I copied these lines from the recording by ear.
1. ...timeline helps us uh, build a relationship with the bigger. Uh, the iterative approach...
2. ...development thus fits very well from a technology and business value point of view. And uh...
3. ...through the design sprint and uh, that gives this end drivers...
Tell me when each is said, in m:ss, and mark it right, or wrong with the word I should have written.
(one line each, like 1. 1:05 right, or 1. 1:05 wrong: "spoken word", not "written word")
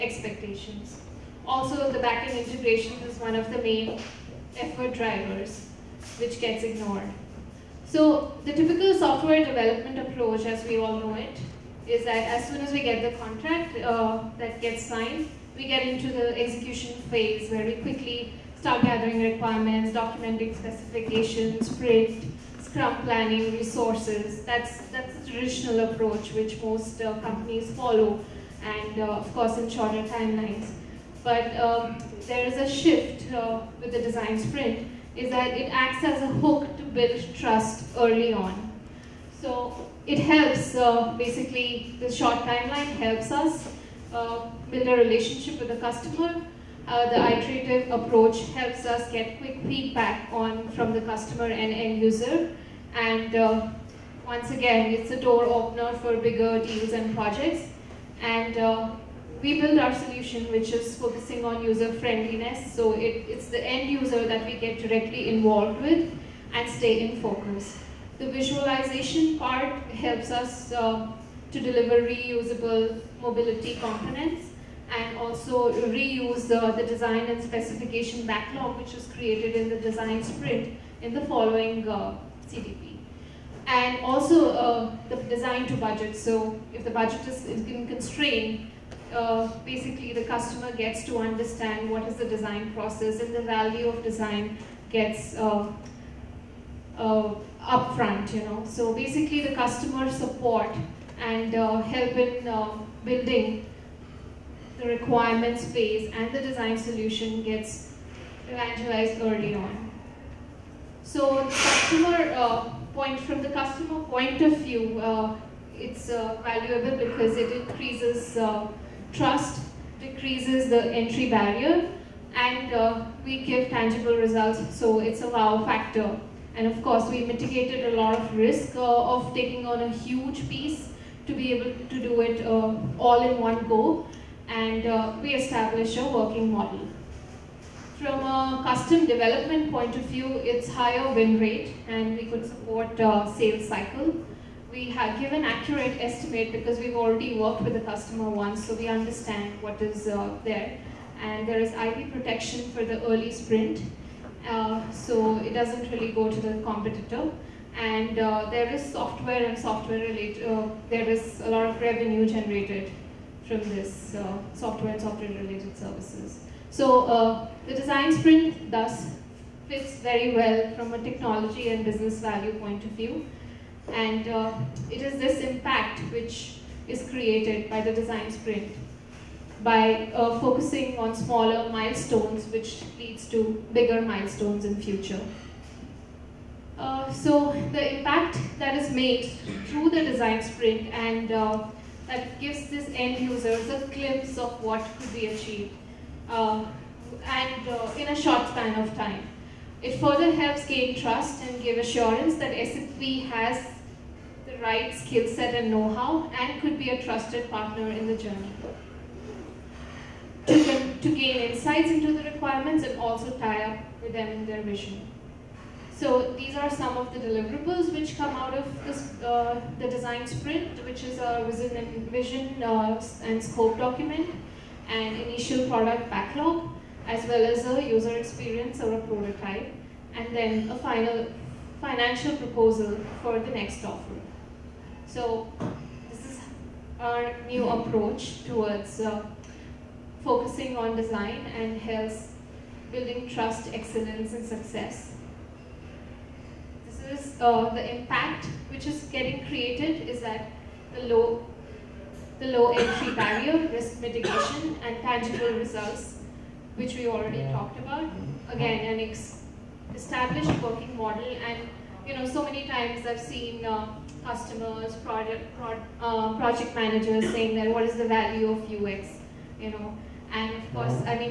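1. 0:42 wrong: "customer", not "bigger"
2. 2:48 wrong: "sprint", not "development"
3. 3:09 wrong: "users", not "drivers".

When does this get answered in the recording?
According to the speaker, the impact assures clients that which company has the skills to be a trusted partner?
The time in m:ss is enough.
3:22.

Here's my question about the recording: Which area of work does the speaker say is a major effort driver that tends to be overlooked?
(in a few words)
backend integration.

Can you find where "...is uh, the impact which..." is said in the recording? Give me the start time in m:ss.
4:07.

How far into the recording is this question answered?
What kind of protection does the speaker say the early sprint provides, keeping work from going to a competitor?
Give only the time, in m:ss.
2:31.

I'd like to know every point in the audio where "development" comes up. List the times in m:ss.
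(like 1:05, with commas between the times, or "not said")
0:09, 2:19.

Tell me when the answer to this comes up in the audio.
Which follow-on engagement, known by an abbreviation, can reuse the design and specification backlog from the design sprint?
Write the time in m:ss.
1:22.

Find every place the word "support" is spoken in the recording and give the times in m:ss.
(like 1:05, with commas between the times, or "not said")
1:40, 2:22.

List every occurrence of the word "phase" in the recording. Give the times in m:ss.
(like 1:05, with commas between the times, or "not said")
0:17, 1:45.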